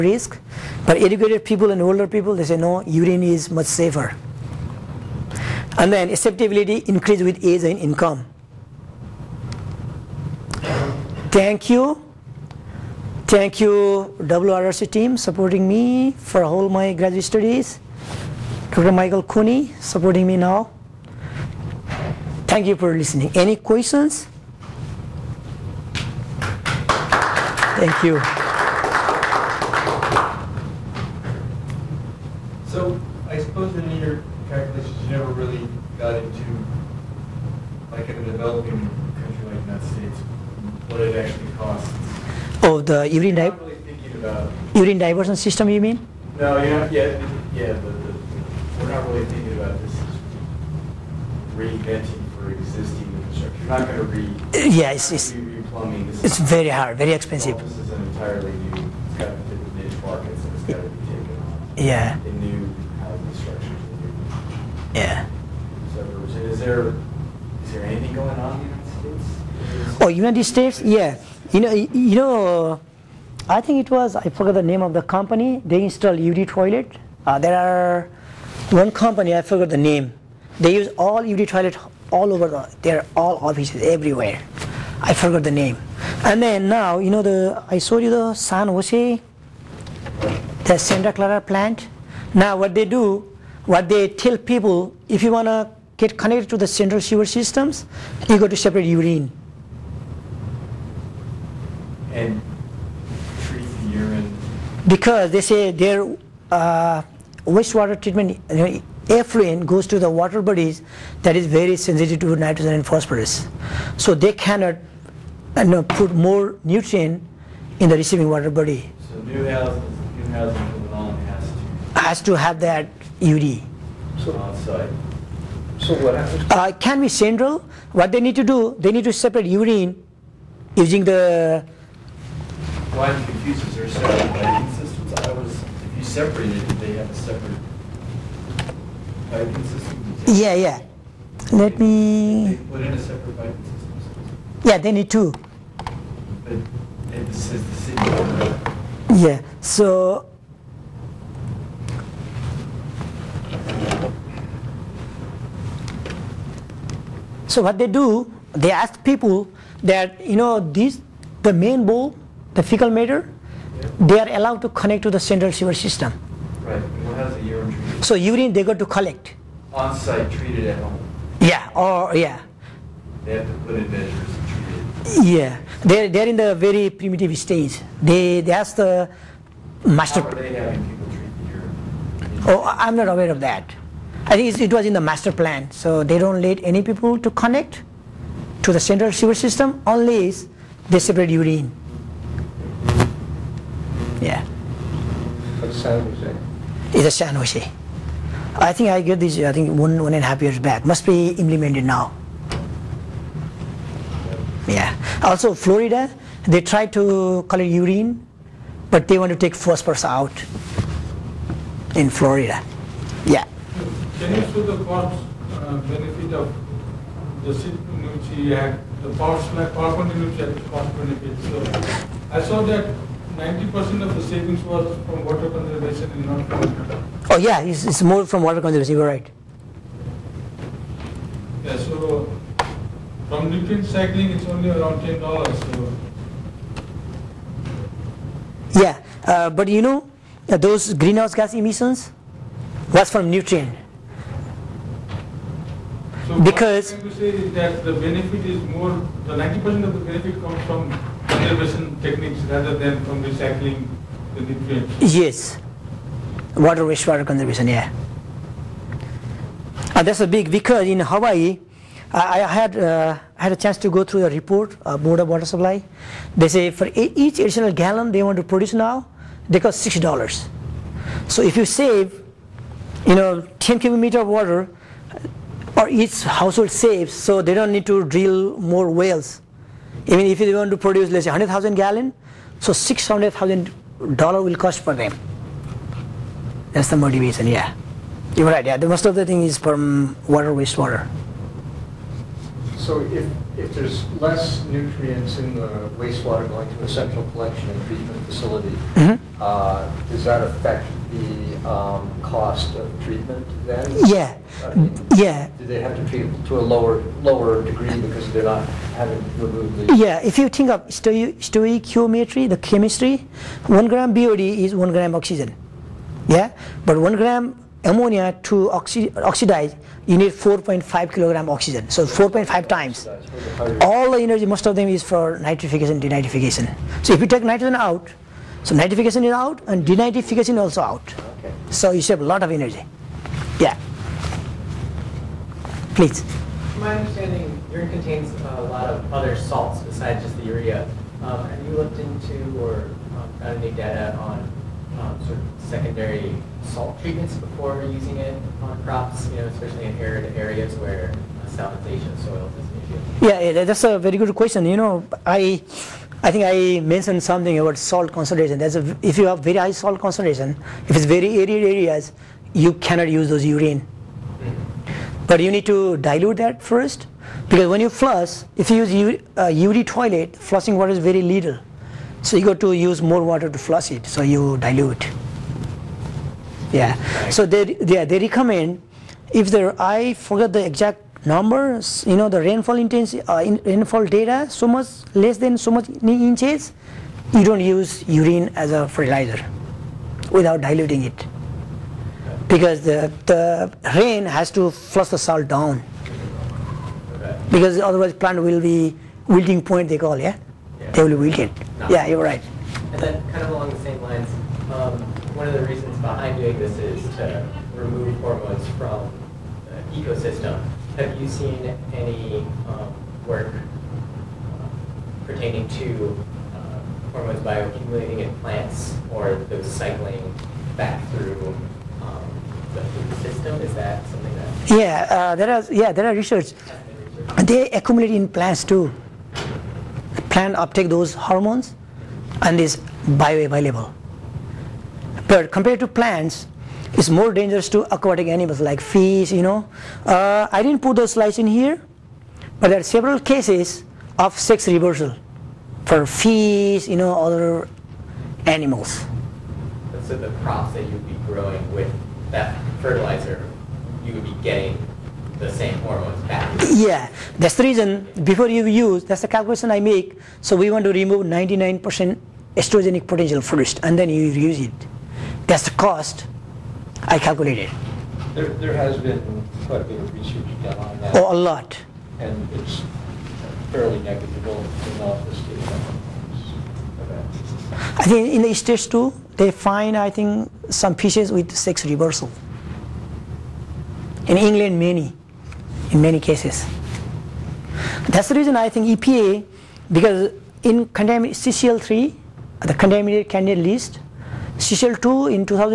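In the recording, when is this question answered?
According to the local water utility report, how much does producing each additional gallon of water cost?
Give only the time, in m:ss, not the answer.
4:29.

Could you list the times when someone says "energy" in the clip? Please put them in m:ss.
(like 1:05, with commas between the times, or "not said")
5:24, 5:32.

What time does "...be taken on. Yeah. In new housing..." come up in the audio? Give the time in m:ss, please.
1:00.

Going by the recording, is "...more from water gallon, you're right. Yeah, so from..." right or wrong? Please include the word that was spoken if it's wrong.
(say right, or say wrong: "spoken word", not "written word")
wrong: "conservation", not "gallon".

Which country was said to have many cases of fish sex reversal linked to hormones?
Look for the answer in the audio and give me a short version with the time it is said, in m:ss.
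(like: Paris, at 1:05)
England, at 8:04.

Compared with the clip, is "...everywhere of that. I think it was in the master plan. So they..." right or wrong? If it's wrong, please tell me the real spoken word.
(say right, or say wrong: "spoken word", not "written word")
wrong: "aware", not "everywhere".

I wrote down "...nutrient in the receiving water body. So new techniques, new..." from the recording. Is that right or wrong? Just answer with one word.
wrong.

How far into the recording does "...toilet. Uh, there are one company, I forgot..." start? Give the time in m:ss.
1:16.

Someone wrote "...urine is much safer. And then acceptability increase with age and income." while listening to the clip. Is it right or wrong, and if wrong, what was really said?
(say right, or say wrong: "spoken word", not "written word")
right.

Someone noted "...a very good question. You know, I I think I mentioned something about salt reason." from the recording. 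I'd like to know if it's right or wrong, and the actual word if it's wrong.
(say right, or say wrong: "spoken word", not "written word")
wrong: "concentration", not "reason".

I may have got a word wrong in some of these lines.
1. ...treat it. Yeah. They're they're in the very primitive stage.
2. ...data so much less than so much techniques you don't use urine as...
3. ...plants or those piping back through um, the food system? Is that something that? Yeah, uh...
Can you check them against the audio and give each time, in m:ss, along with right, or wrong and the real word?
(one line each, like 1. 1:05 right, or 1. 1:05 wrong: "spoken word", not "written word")
1. 2:55 right
2. 6:24 wrong: "inches", not "techniques"
3. 6:58 wrong: "cycling", not "piping".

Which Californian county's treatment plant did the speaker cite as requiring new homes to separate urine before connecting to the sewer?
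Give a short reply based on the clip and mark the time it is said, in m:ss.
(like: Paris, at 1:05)
Santa Clara, at 1:30.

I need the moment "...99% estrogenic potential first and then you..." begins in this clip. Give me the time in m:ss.
7:41.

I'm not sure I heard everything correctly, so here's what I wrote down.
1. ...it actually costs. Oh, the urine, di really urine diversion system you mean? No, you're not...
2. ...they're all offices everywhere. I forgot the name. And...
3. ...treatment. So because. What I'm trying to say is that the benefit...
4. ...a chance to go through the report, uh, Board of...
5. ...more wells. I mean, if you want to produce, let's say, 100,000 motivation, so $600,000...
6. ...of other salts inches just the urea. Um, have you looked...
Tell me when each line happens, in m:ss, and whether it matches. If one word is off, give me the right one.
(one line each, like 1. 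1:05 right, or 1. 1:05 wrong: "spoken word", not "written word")
1. 0:41 right
2. 1:22 right
3. 4:03 wrong: "nutrient", not "treatment"
4. 4:23 right
5. 4:38 wrong: "gallon", not "motivation"
6. 5:38 wrong: "besides", not "inches".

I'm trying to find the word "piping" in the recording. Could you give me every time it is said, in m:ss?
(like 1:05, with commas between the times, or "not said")
2:19, 2:23.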